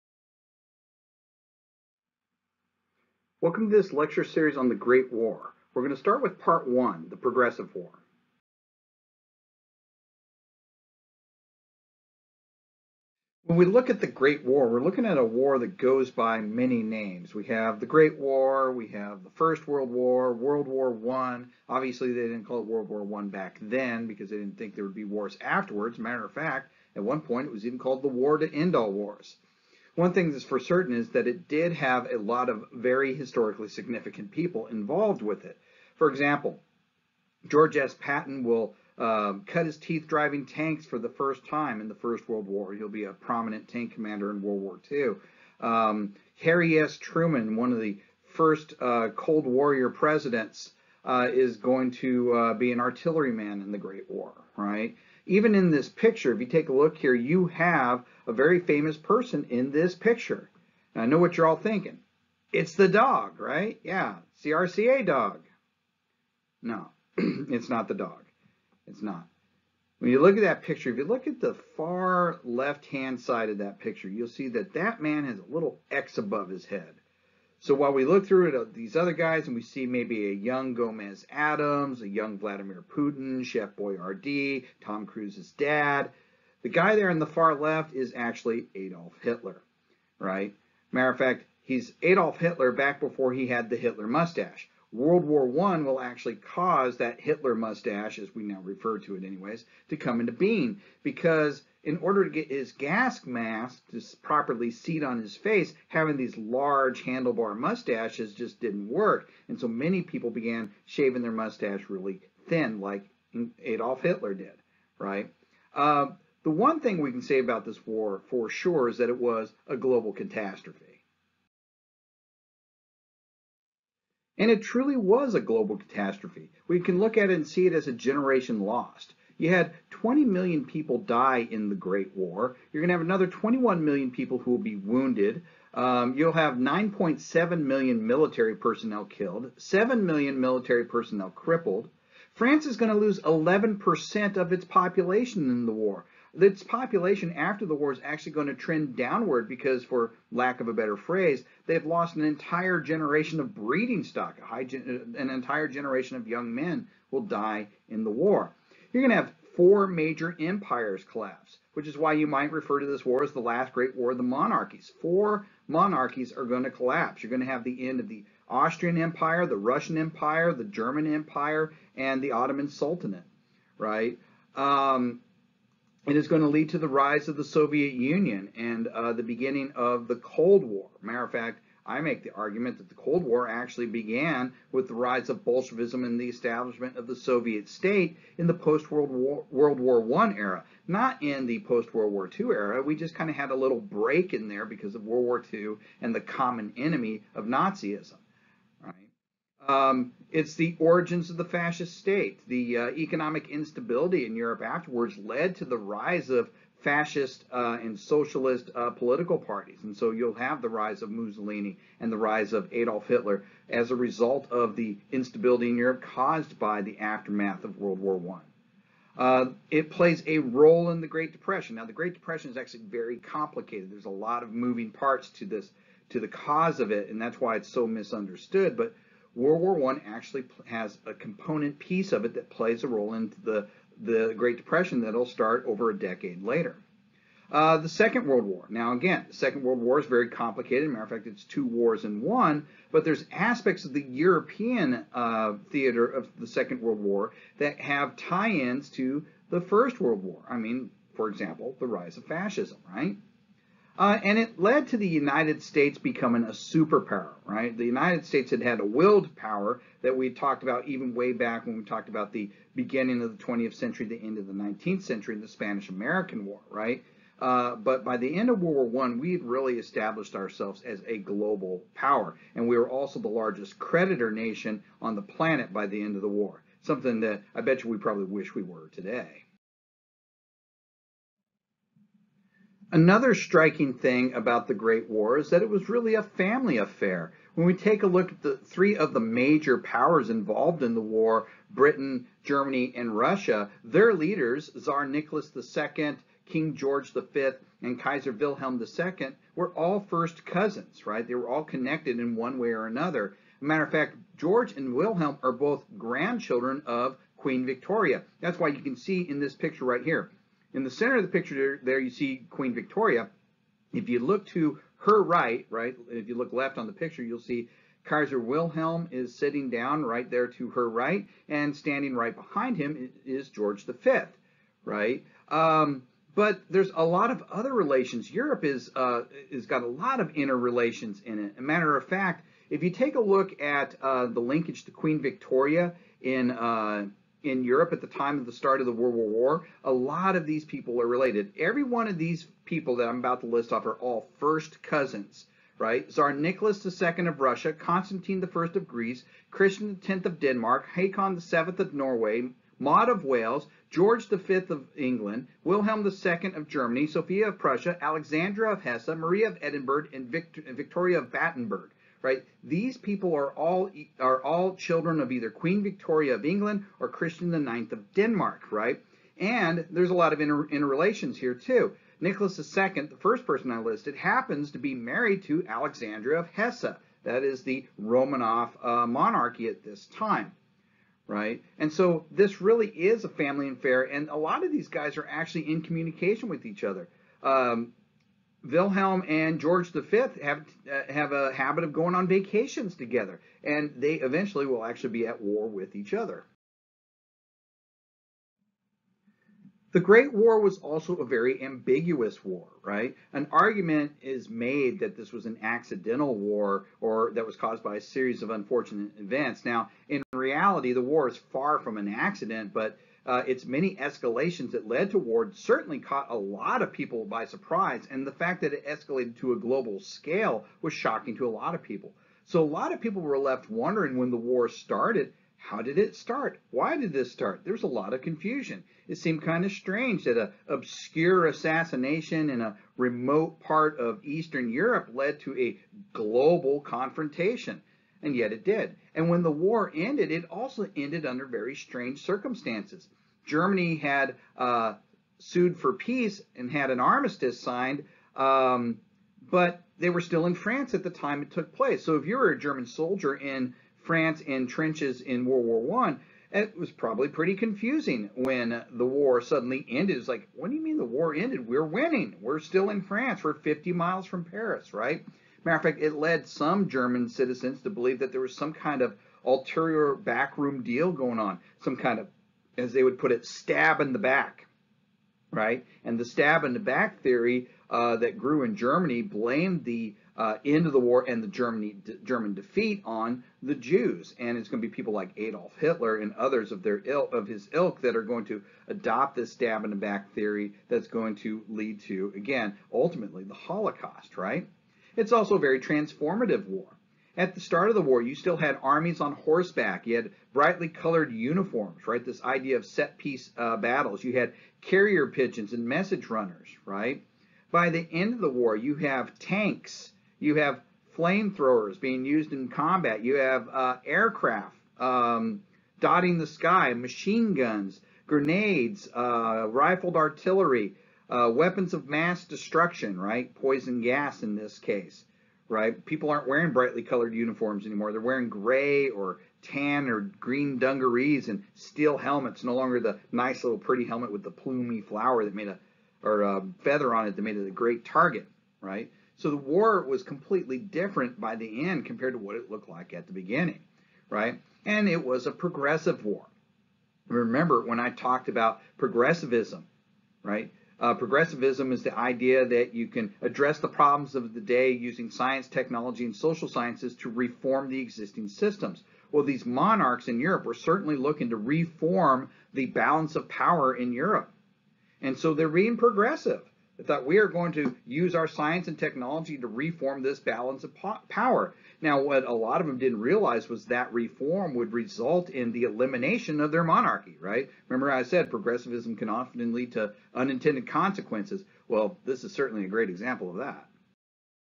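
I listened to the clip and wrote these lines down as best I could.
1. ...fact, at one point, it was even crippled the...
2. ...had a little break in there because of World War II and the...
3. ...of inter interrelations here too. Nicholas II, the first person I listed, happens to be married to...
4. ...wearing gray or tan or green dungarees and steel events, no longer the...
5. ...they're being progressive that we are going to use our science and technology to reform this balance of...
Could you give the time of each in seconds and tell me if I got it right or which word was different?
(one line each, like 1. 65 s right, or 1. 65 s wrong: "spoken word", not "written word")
1. 26 s wrong: "called", not "crippled"
2. 193 s right
3. 370 s right
4. 528 s wrong: "helmets", not "events"
5. 565 s right.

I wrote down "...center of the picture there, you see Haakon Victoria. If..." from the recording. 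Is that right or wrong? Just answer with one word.
wrong.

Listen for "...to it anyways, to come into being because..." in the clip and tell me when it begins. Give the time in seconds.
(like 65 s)
98 s.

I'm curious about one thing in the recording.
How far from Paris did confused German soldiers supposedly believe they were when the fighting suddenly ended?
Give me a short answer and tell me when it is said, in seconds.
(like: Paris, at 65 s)
50 miles, at 463 s.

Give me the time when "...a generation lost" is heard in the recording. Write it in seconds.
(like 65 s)
127 s.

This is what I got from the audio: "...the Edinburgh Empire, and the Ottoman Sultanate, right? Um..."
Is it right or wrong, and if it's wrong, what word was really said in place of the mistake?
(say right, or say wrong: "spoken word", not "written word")
wrong: "German", not "Edinburgh".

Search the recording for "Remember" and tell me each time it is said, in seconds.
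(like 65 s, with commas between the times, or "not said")
547 s, 577 s.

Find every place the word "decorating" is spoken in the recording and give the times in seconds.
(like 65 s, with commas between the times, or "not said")
not said.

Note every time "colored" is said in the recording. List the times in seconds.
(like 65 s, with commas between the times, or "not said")
500 s, 527 s.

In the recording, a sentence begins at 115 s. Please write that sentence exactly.
Uh, the one thing we can say about this war for sure is that it was a global catastrophe.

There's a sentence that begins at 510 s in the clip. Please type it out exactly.
You have flamethrowers being used in combat.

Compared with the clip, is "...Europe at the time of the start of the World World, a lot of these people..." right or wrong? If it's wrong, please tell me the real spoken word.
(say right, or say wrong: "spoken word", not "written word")
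wrong: "War", not "World".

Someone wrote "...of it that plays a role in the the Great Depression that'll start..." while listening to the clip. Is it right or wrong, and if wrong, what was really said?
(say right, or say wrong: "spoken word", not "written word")
right.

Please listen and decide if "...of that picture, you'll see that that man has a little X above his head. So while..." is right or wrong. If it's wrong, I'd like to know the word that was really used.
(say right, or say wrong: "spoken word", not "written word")
right.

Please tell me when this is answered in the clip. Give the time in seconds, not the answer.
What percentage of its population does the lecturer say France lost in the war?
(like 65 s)
143 s.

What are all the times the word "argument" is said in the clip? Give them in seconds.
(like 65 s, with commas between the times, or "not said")
182 s, 403 s.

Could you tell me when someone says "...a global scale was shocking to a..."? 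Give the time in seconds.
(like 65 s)
419 s.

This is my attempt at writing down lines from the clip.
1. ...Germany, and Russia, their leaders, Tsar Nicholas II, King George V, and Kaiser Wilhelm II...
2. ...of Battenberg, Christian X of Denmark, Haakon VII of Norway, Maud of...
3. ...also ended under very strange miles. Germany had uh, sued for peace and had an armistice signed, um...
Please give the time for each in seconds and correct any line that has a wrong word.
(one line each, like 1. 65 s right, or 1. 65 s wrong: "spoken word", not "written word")
1. 292 s right
2. 348 s wrong: "Greece", not "Battenberg"
3. 440 s wrong: "circumstances", not "miles".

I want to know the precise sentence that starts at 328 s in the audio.
Europe is uh, got a lot of interrelations in it.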